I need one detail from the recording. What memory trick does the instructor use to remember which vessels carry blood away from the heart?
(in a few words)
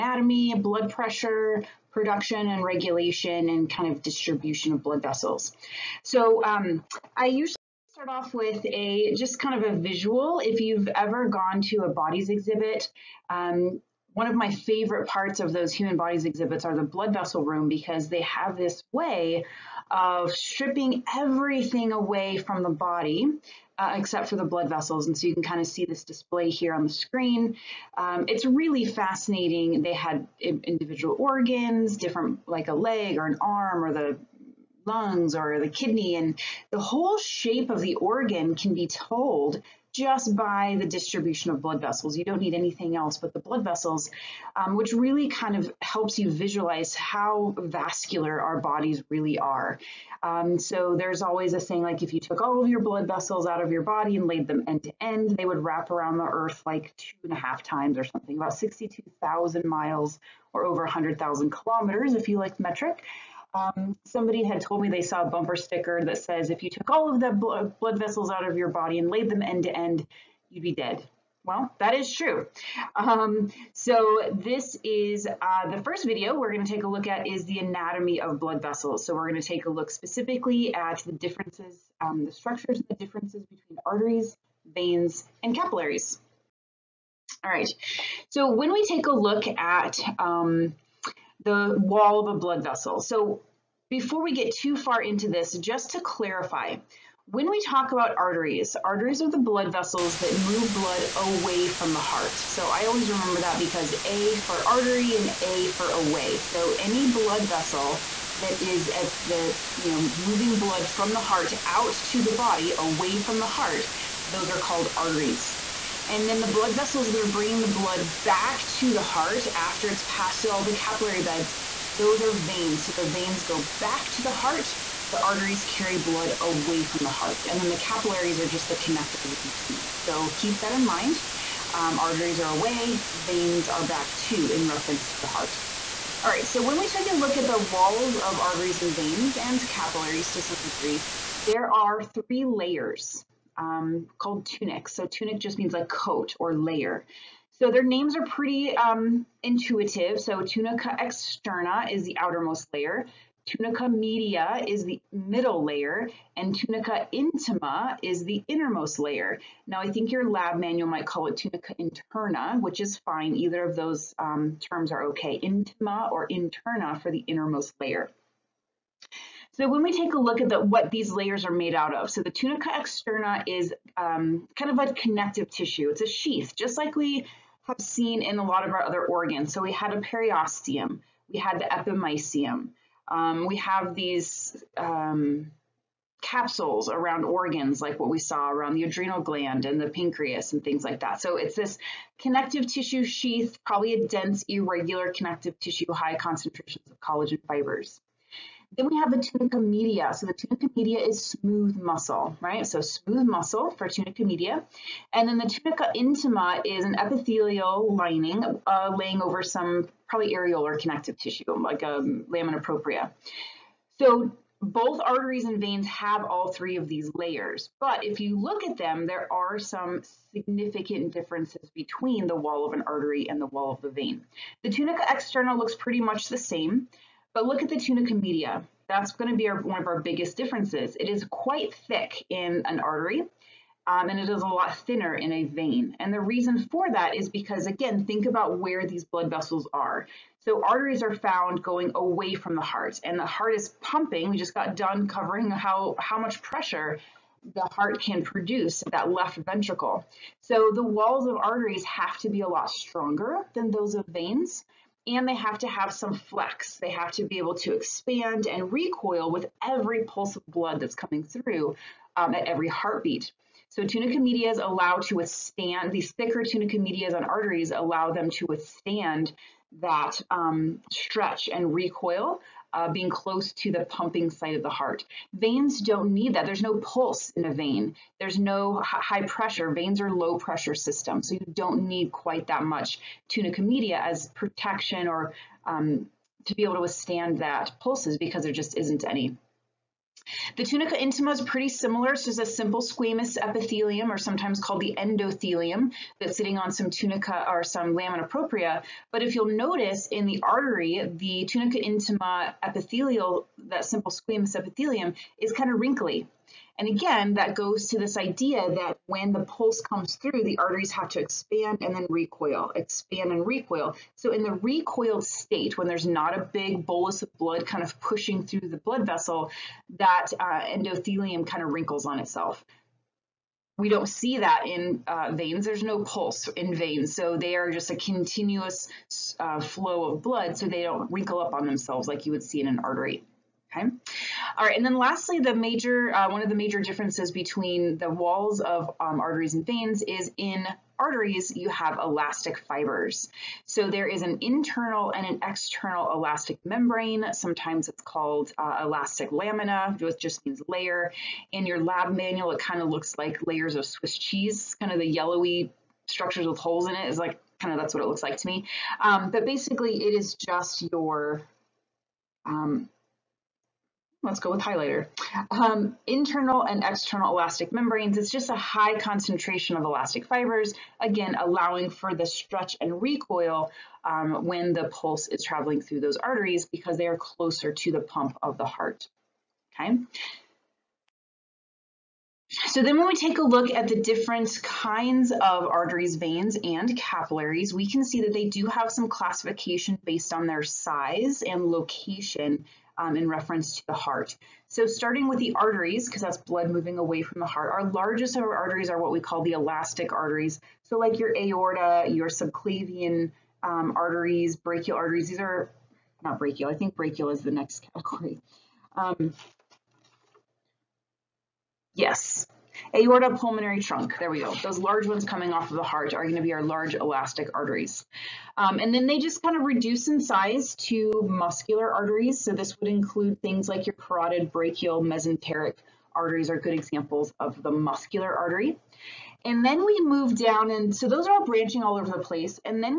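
A for artery and A for away.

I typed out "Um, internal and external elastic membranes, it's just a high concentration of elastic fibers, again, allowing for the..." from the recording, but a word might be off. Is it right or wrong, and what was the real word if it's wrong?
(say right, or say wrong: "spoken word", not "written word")
right.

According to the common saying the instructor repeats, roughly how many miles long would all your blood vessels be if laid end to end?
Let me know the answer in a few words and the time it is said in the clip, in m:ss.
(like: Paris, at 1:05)
62,000 miles, at 0:58.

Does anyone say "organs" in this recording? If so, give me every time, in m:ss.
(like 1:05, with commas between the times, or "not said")
0:31, 0:37, 2:59, 3:07.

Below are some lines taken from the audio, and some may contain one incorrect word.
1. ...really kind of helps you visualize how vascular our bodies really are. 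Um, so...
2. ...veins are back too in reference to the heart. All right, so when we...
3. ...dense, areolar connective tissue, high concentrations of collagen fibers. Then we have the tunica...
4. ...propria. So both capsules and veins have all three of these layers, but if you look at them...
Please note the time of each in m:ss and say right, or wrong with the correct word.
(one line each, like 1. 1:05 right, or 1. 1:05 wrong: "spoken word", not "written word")
1. 0:44 right
2. 2:13 right
3. 3:14 wrong: "irregular", not "areolar"
4. 3:32 wrong: "arteries", not "capsules".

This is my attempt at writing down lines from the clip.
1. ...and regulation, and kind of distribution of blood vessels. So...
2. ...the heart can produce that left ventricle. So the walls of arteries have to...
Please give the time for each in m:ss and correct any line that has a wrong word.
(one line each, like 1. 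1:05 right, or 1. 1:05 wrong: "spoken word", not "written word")
1. 0:02 right
2. 4:07 right.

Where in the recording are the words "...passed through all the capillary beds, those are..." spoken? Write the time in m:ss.
2:00.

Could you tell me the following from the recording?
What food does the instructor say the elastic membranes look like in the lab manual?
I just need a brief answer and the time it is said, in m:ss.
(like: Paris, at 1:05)
Swiss cheese, at 5:53.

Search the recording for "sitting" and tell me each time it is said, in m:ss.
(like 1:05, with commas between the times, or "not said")
4:56.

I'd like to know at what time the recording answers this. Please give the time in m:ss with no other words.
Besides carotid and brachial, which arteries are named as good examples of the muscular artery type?
7:05.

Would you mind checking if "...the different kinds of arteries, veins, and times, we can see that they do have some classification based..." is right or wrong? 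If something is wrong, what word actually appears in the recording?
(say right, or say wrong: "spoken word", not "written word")
wrong: "capillaries", not "times".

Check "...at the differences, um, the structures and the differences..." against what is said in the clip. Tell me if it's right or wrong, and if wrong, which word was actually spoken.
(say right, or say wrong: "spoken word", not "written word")
right.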